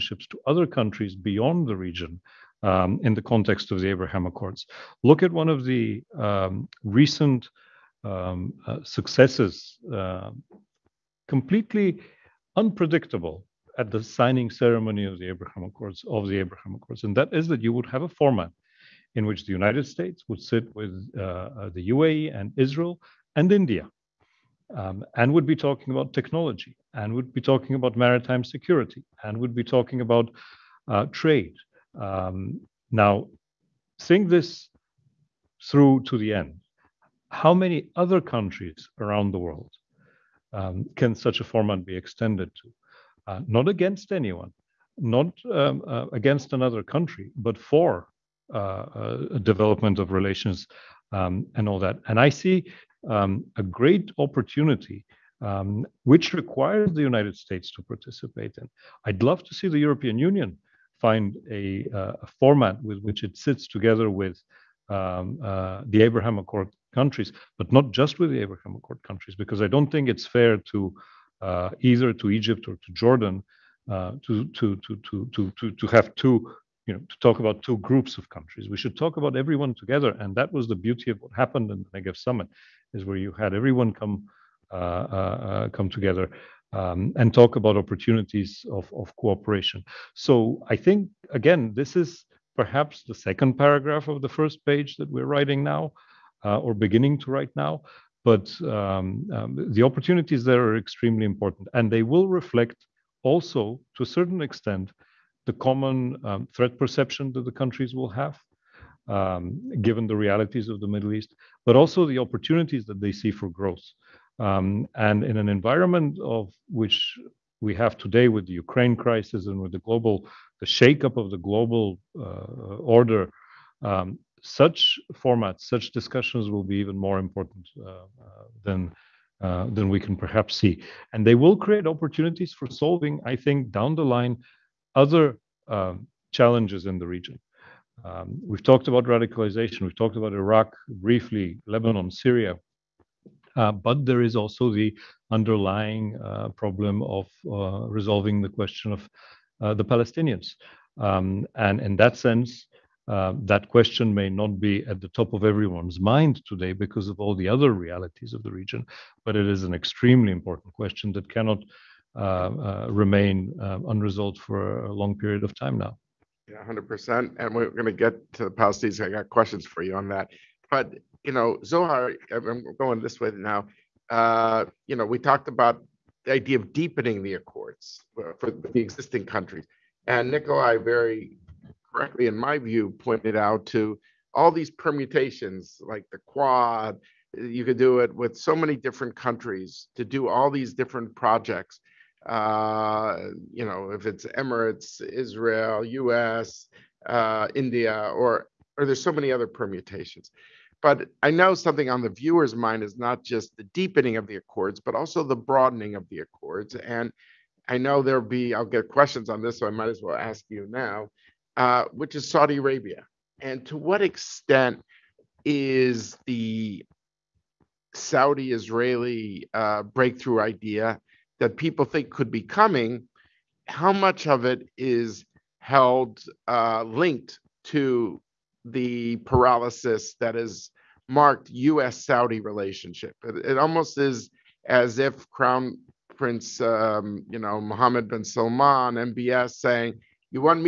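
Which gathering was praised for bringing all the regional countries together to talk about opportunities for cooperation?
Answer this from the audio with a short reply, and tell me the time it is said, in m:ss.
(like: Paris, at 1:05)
Negev summit, at 1:21.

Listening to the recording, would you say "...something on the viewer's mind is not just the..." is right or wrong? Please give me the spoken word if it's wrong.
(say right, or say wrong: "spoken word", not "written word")
right.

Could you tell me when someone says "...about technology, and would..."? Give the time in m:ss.
0:25.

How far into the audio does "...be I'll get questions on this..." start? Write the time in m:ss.
3:28.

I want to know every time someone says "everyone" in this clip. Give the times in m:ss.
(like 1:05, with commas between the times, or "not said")
1:19, 1:23, 2:35.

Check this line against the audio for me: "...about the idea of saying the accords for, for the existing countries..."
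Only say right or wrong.
wrong.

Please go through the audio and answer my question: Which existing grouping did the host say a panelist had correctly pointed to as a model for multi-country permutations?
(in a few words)
the Quad.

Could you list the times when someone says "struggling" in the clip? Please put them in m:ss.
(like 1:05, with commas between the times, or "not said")
not said.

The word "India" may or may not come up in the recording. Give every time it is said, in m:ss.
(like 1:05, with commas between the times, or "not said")
0:23, 3:17.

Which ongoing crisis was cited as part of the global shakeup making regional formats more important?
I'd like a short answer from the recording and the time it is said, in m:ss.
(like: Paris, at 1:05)
Ukraine crisis, at 1:58.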